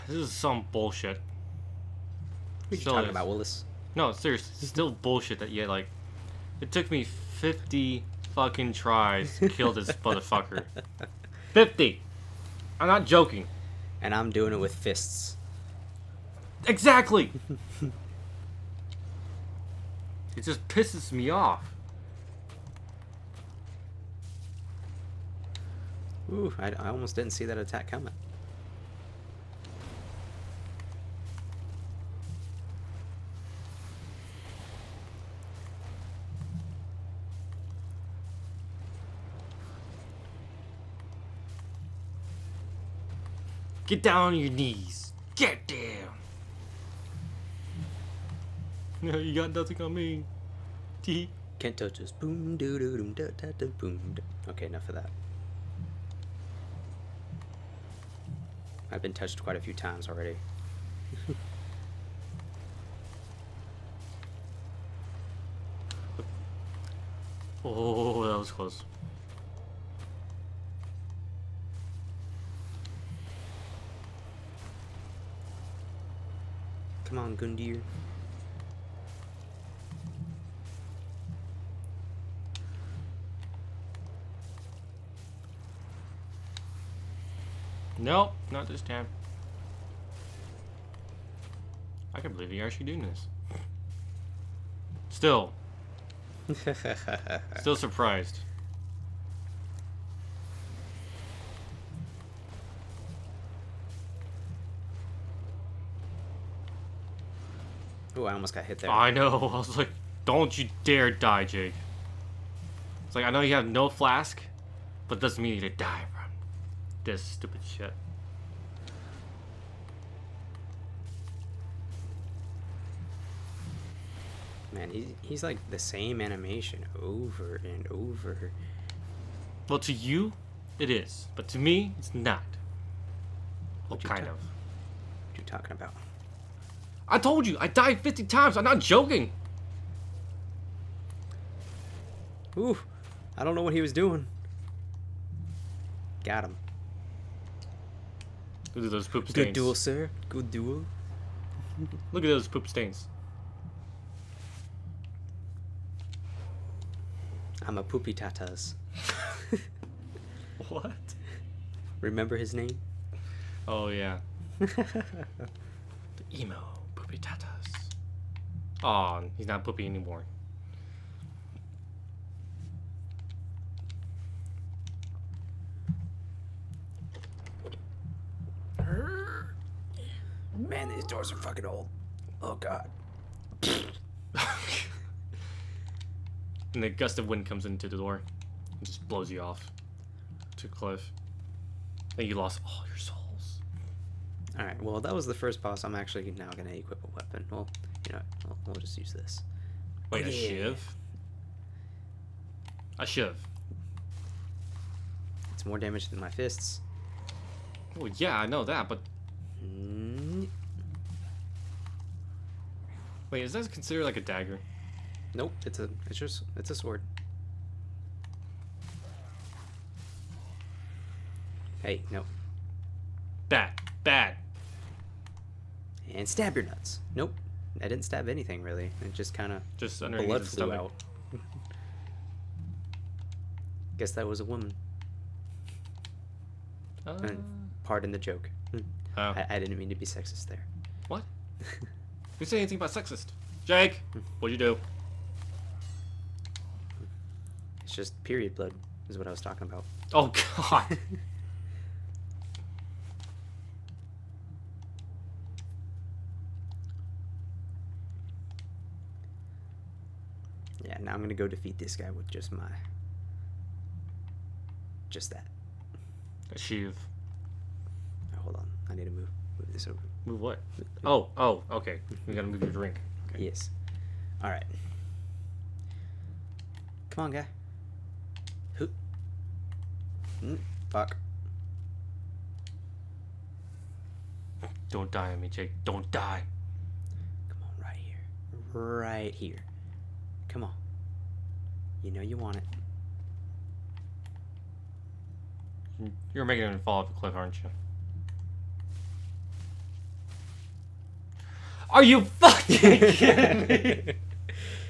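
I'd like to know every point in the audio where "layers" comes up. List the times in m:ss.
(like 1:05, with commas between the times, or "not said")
not said.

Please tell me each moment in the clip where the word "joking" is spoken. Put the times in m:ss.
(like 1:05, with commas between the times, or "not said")
0:13, 2:18.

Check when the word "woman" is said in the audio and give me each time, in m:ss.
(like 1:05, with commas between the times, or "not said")
3:54.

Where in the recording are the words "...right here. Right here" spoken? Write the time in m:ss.
4:47.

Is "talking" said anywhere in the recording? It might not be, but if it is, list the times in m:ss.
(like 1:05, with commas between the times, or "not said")
0:02, 2:15, 4:09.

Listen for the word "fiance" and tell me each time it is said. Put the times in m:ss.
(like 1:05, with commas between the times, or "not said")
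not said.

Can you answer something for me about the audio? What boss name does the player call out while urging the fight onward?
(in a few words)
Gundyr.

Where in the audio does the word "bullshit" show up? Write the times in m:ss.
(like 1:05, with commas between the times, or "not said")
0:00, 0:04.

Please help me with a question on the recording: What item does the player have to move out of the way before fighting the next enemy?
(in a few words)
Drink.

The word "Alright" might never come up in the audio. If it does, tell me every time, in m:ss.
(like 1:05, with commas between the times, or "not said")
3:14, 4:34.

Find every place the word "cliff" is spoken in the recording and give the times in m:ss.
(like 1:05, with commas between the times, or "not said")
3:10, 4:57.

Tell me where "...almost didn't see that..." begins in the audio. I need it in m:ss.
0:26.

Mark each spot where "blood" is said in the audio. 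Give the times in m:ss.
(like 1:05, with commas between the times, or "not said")
3:50, 4:08.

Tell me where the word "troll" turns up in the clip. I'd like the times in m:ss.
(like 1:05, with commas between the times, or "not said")
not said.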